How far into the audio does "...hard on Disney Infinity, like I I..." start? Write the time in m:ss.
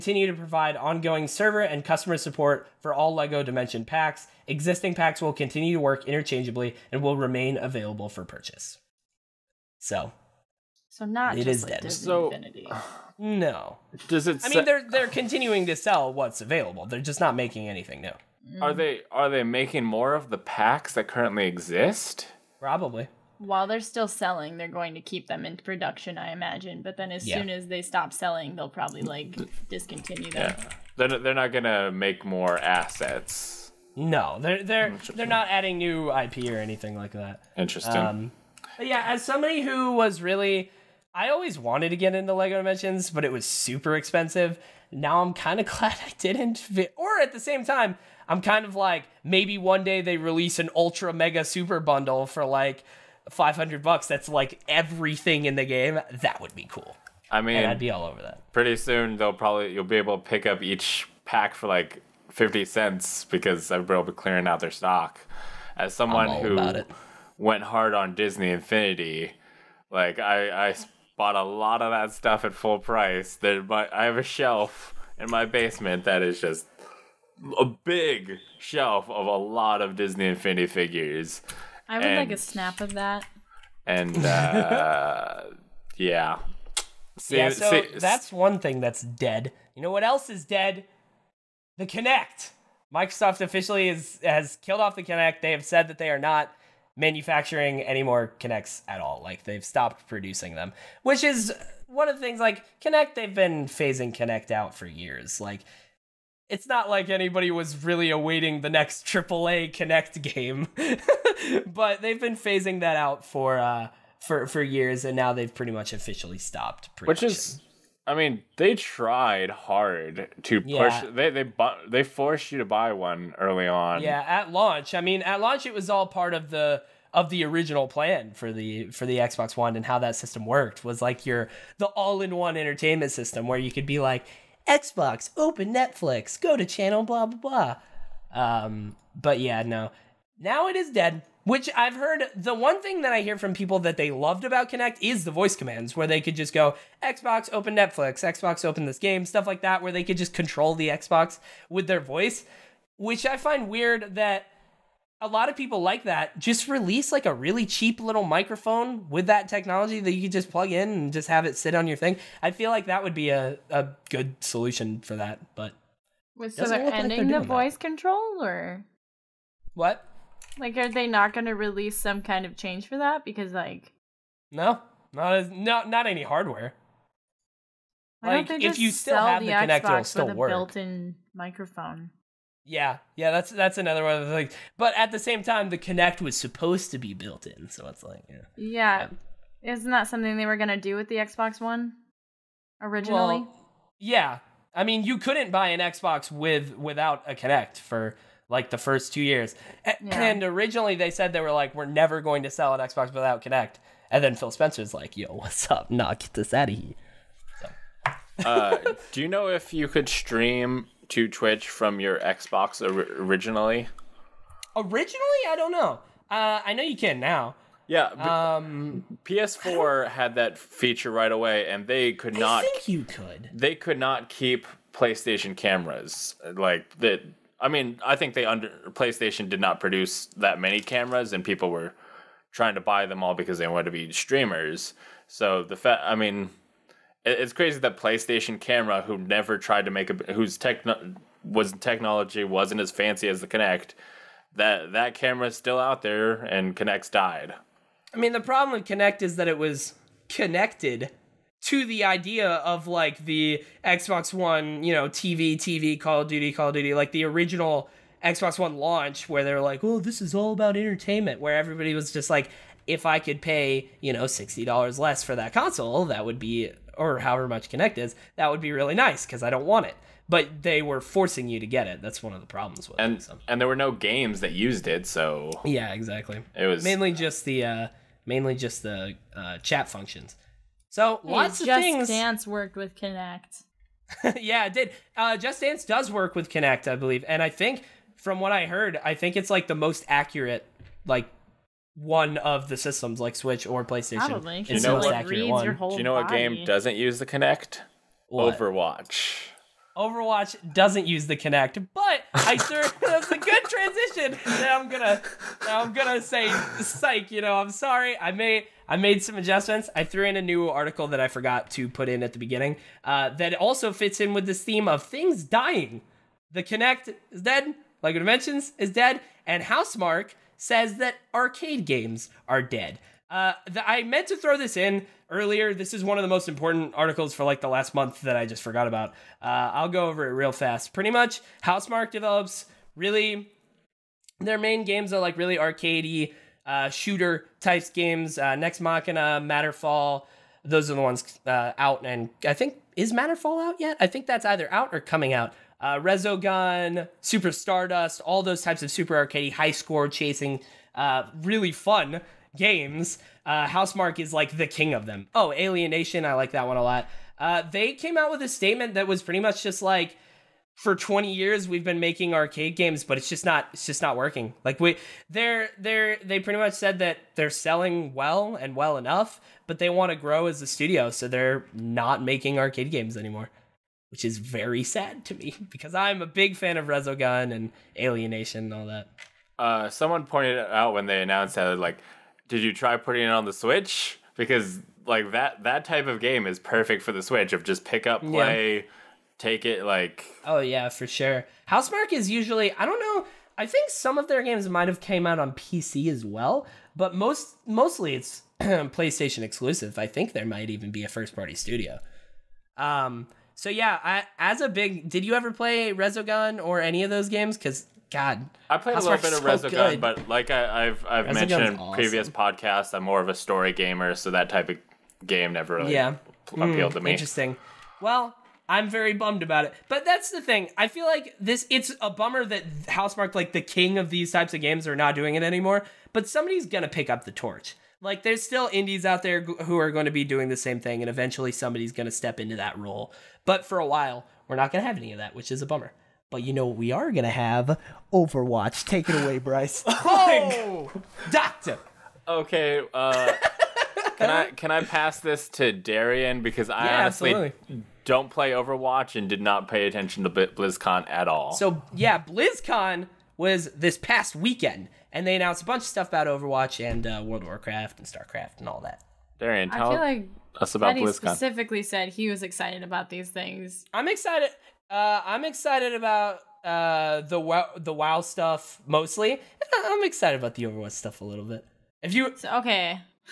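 1:07.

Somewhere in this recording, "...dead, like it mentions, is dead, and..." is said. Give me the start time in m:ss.
5:17.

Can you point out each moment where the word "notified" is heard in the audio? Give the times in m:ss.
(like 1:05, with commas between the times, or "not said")
not said.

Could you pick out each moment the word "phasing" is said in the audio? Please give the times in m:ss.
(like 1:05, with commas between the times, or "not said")
1:43, 1:52.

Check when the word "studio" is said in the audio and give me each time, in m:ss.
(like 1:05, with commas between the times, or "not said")
6:10, 6:41.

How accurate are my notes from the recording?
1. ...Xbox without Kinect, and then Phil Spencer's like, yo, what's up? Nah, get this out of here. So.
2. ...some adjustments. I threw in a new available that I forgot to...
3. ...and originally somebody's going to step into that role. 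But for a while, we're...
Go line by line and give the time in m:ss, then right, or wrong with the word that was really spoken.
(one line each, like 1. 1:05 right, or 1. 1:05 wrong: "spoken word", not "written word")
1. 3:22 right
2. 5:09 wrong: "article", not "available"
3. 7:11 wrong: "eventually", not "originally".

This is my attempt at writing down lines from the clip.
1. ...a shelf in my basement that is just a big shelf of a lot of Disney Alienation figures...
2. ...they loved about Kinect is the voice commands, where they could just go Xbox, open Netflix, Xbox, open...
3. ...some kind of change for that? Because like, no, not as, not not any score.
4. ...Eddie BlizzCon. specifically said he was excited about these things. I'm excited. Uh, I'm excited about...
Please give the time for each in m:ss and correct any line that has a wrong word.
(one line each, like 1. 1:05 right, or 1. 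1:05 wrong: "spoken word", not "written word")
1. 1:14 wrong: "Infinity", not "Alienation"
2. 2:23 right
3. 2:51 wrong: "hardware", not "score"
4. 7:40 right.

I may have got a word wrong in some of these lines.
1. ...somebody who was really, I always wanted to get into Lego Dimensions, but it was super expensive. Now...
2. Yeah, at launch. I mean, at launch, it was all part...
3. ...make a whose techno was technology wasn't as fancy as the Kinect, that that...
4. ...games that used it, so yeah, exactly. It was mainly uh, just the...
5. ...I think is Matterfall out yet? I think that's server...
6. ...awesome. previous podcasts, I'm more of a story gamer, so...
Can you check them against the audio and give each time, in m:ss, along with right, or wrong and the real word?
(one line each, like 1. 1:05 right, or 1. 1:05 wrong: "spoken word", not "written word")
1. 0:39 right
2. 2:04 right
3. 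3:59 right
4. 4:33 right
5. 5:42 wrong: "either", not "server"
6. 6:51 right.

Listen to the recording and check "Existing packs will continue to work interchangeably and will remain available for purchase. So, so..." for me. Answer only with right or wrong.
right.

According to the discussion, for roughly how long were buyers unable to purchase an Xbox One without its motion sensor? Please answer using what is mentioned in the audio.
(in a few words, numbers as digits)
2 years.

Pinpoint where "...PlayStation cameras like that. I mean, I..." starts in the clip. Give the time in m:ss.
3:44.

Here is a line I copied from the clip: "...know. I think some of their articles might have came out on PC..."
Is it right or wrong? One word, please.
wrong.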